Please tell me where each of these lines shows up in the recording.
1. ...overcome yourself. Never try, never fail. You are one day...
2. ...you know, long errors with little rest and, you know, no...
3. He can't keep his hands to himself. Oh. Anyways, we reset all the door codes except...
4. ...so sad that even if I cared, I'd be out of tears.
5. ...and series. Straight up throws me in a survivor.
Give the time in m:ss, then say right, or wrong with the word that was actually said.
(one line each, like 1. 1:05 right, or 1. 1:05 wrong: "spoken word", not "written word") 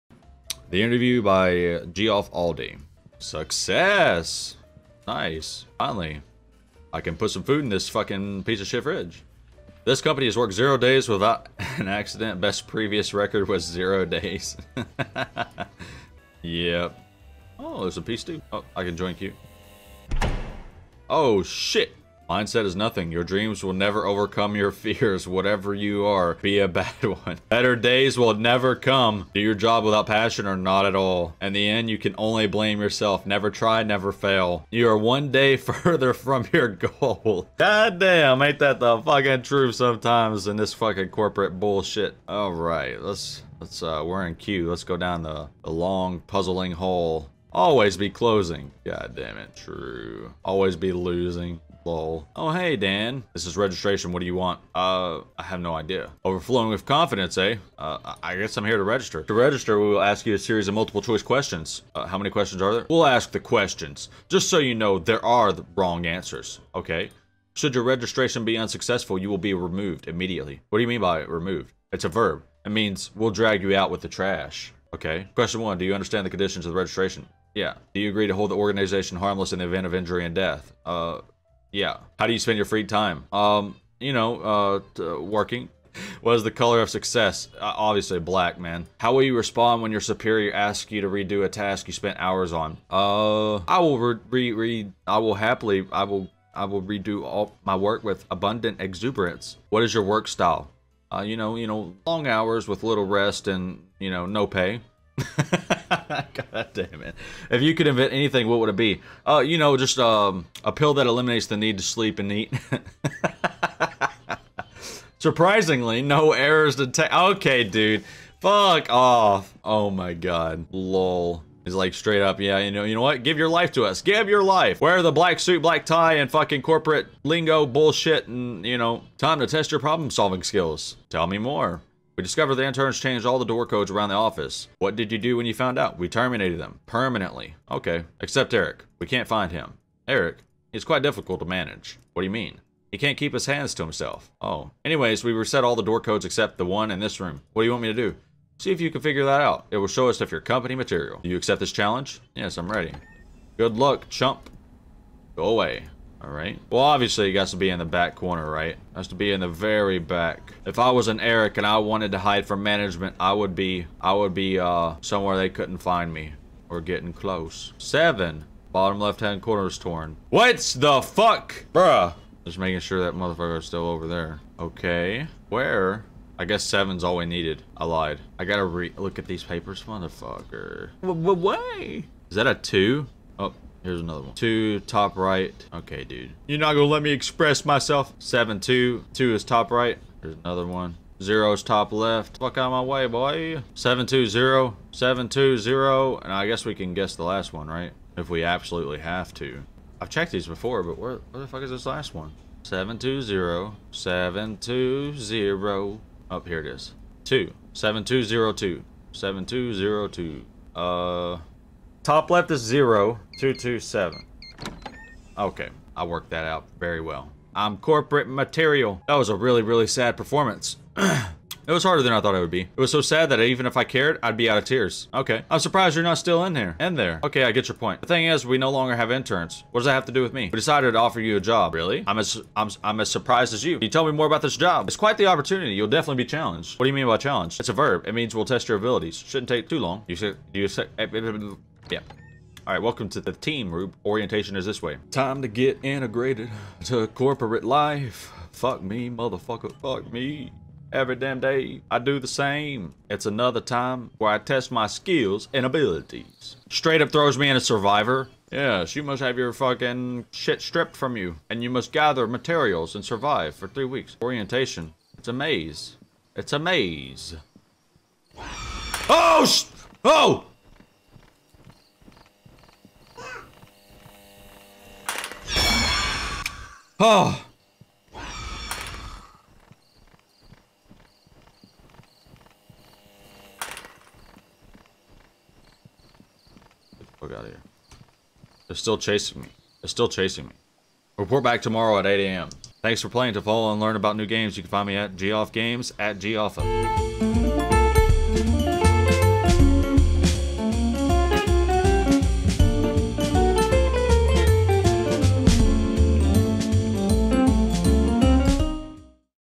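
1. 0:32 wrong: "blame", not "overcome"
2. 1:41 wrong: "hours", not "errors"
3. 2:22 right
4. 3:42 right
5. 4:15 wrong: "abilities", not "series".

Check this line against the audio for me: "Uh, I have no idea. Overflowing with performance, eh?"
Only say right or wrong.
wrong.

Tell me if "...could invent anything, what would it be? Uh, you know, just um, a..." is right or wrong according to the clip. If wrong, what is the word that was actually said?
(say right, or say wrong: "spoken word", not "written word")
right.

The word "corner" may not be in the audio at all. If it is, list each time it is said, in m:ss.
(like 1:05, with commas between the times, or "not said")
2:38, 2:49.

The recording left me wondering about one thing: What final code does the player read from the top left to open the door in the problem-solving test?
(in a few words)
0227.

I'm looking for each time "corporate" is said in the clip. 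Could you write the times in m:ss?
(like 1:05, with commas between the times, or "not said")
0:41, 2:06, 3:37, 4:07.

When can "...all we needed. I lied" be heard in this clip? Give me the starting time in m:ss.
2:57.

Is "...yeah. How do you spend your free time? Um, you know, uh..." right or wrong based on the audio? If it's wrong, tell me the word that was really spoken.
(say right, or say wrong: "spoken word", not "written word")
right.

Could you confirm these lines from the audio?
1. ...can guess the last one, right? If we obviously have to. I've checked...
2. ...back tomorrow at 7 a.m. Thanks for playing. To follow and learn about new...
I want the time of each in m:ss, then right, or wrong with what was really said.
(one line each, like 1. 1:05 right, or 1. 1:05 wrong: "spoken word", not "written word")
1. 3:16 wrong: "absolutely", not "obviously"
2. 4:51 wrong: "8", not "7".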